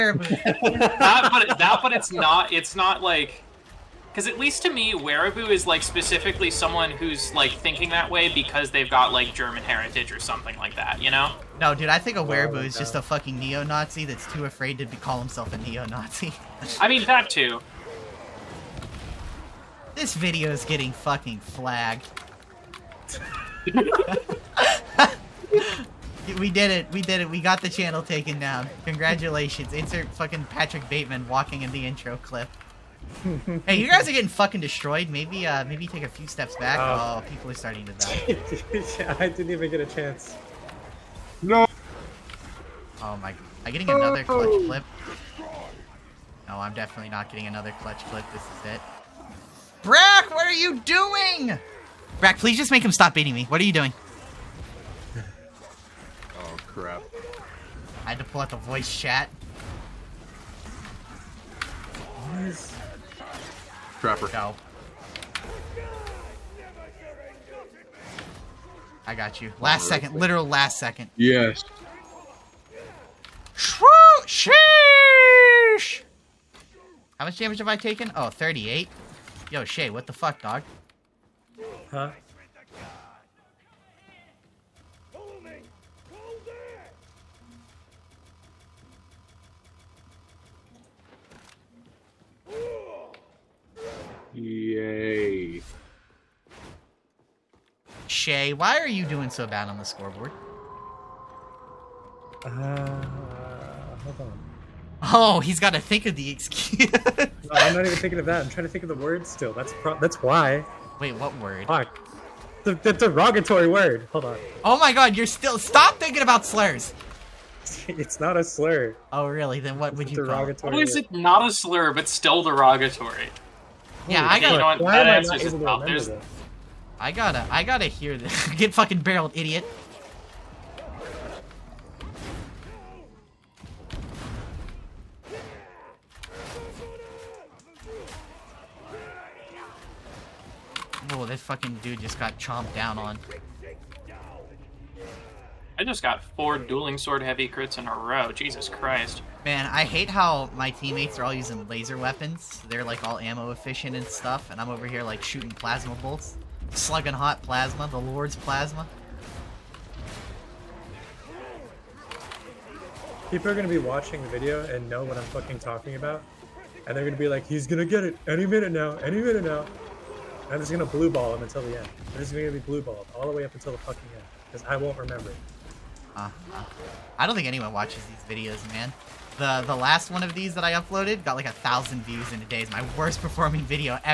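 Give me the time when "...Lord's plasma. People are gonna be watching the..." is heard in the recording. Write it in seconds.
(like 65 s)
157 s.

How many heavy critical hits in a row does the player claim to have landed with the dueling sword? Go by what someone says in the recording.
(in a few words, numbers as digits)
4.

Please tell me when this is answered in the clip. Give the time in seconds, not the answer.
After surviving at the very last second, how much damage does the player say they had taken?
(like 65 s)
78 s.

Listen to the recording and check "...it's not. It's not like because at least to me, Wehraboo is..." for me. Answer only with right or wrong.
right.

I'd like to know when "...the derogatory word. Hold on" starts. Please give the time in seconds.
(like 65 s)
112 s.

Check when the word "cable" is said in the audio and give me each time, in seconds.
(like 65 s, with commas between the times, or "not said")
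not said.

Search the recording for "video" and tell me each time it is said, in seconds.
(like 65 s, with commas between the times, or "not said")
20 s, 164 s, 178 s, 183 s.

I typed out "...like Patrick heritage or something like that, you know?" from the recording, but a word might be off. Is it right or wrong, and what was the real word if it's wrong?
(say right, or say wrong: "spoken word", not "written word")
wrong: "German", not "Patrick".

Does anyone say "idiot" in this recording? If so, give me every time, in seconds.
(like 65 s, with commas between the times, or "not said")
129 s.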